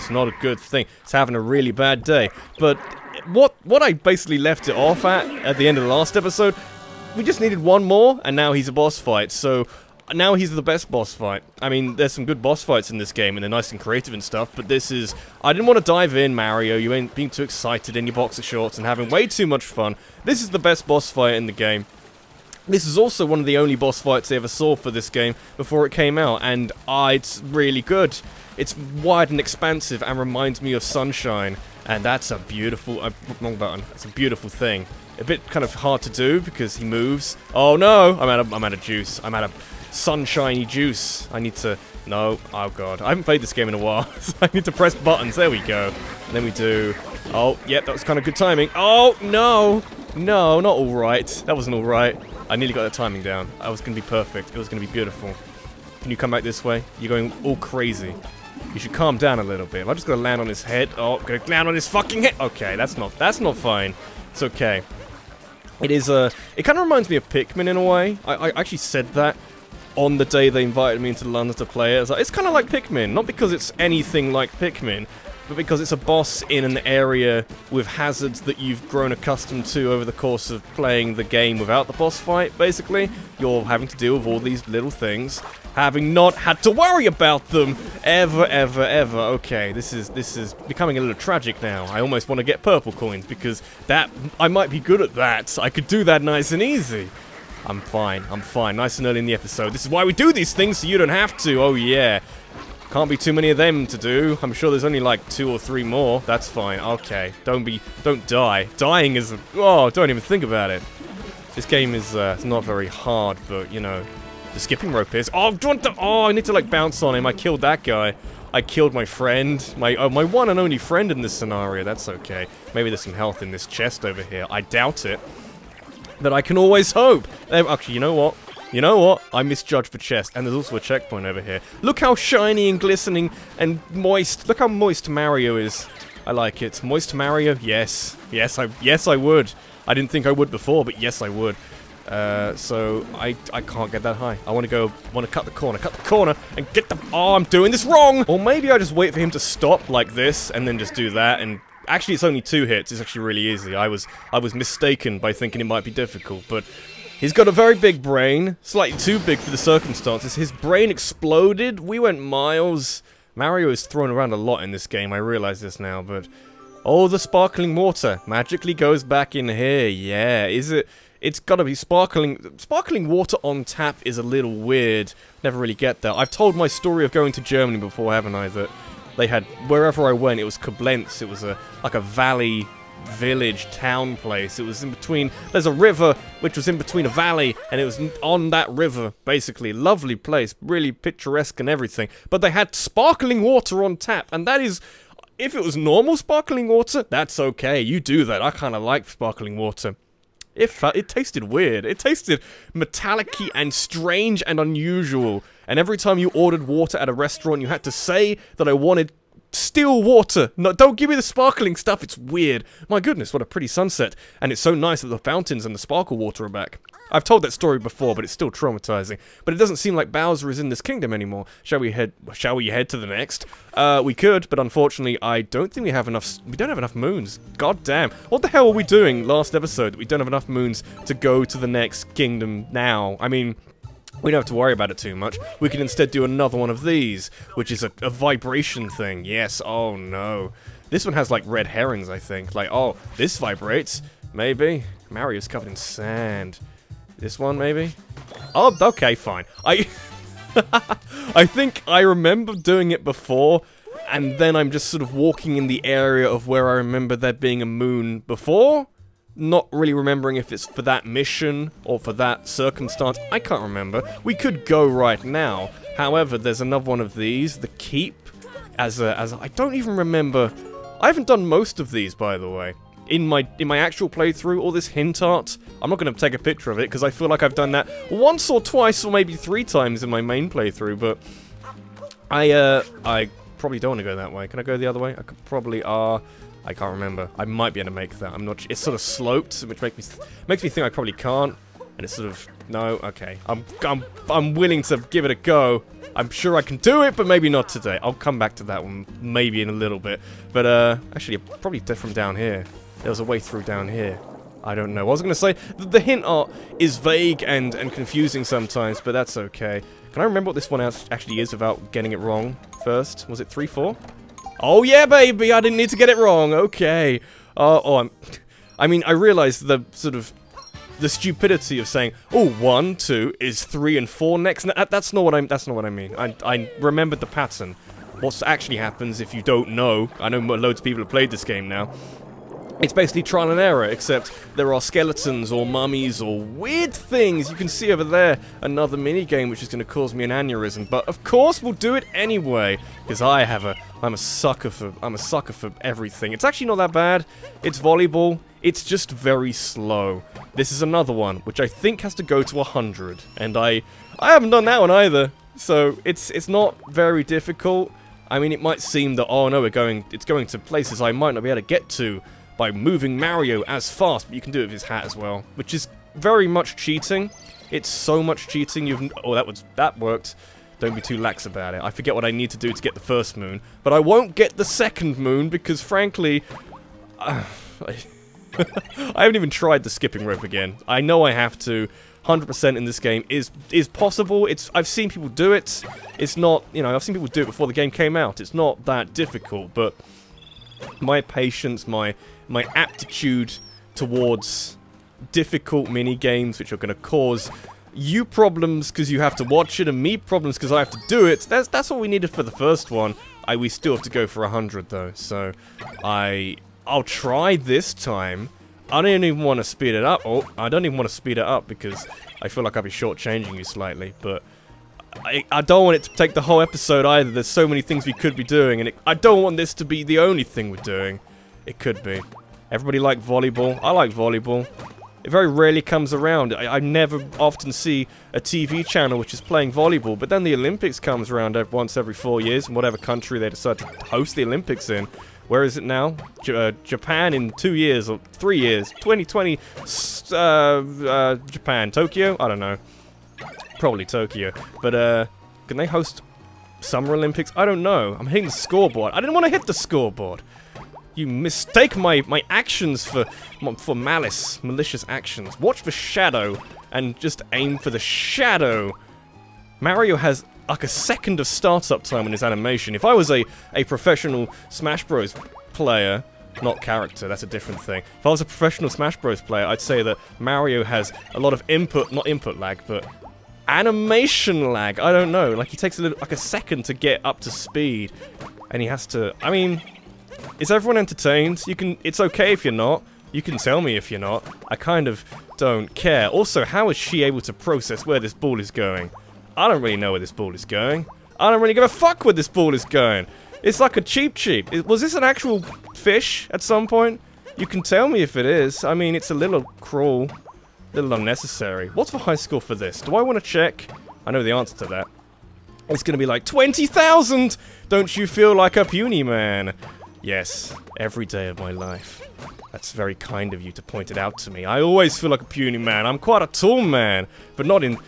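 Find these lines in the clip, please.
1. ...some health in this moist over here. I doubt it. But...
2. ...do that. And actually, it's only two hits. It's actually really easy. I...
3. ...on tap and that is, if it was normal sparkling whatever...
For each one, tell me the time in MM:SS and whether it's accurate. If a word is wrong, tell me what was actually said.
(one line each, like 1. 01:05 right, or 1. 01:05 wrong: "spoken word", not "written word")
1. 02:03 wrong: "chest", not "moist"
2. 02:30 right
3. 03:13 wrong: "water", not "whatever".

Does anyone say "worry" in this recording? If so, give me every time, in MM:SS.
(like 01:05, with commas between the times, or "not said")
01:26, 03:54.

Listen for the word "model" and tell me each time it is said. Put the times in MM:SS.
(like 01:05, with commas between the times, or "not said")
not said.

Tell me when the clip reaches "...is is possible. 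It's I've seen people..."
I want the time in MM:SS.
06:23.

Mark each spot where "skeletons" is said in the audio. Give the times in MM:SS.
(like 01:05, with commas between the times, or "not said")
05:34.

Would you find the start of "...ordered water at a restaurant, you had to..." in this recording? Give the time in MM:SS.
03:26.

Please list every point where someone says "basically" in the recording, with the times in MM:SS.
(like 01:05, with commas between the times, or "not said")
00:03, 01:22, 03:09, 05:32.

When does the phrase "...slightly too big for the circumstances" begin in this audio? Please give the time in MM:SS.
02:38.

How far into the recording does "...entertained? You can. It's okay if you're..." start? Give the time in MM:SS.
08:00.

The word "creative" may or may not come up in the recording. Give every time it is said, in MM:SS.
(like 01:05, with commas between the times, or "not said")
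00:13.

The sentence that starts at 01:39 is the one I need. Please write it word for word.
This is why we do these things so you don't have to.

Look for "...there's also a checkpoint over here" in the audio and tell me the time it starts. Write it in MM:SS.
02:10.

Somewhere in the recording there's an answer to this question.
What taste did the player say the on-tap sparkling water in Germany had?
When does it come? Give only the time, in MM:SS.
03:22.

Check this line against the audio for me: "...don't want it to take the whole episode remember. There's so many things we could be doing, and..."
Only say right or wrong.
wrong.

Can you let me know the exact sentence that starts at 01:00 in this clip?
Oh, I'm gonna land on his fucking head.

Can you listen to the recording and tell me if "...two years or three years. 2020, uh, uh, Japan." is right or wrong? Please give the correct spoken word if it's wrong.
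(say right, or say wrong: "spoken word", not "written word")
right.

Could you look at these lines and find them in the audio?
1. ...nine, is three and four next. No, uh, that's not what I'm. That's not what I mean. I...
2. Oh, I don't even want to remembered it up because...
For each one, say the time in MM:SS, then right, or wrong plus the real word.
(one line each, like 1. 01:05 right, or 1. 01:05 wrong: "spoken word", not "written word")
1. 05:22 wrong: "two", not "nine"
2. 06:50 wrong: "speed", not "remembered".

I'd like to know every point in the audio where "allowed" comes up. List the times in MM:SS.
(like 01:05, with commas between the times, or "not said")
not said.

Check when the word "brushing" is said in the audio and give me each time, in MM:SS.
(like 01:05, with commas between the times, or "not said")
not said.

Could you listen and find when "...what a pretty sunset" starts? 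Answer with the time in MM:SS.
03:33.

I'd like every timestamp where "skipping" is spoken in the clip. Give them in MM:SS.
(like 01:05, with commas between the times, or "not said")
01:54, 06:19.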